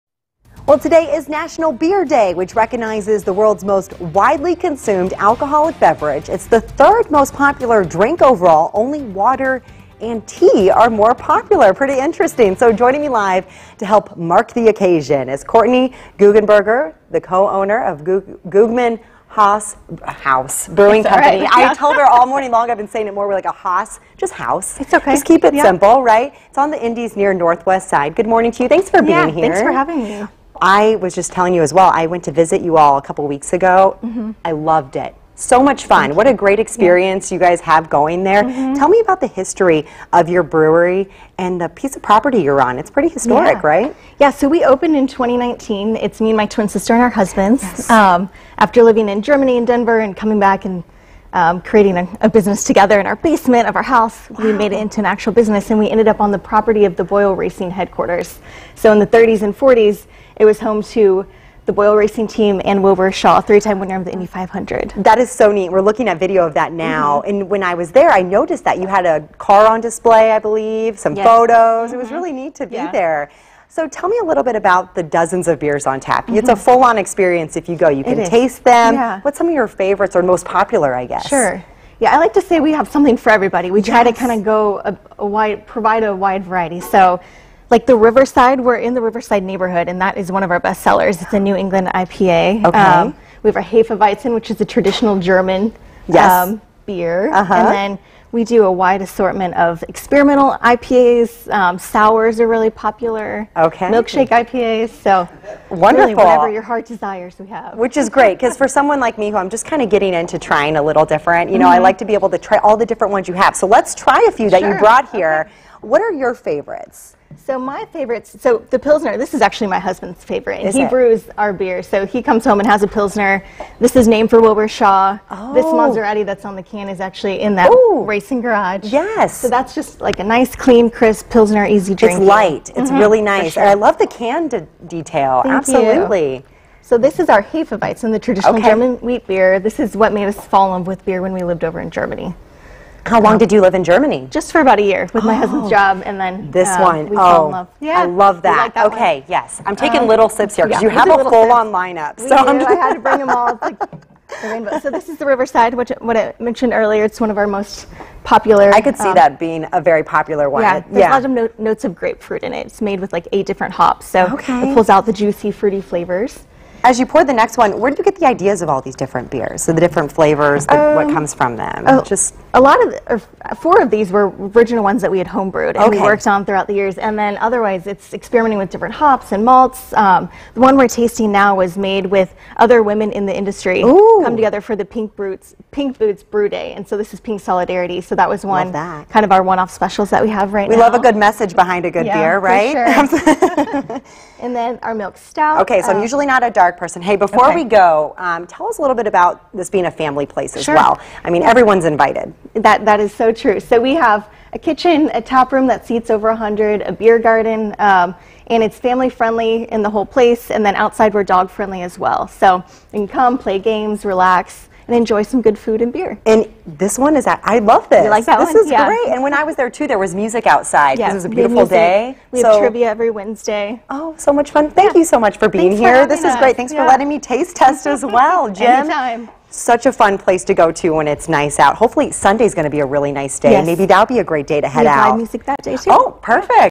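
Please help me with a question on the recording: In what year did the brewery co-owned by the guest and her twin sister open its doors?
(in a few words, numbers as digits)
2019.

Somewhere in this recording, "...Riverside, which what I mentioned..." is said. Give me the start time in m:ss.
2:35.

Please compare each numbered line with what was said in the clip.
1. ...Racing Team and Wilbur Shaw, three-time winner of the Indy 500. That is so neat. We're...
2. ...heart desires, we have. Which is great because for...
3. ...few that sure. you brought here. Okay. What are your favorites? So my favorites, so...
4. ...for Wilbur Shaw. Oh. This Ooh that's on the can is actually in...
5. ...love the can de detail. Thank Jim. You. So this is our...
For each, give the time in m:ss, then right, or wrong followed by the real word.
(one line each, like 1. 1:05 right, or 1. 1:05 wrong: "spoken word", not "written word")
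1. 1:01 right
2. 1:46 right
3. 1:54 right
4. 2:04 wrong: "Maserati", not "Ooh"
5. 2:13 wrong: "Absolutely", not "Jim".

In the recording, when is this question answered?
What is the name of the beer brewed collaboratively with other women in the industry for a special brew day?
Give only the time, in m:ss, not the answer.
3:07.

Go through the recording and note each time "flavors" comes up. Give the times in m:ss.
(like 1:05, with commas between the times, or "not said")
2:45, 2:50.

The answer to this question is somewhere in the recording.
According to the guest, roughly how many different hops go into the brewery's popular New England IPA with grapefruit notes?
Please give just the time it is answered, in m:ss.
2:43.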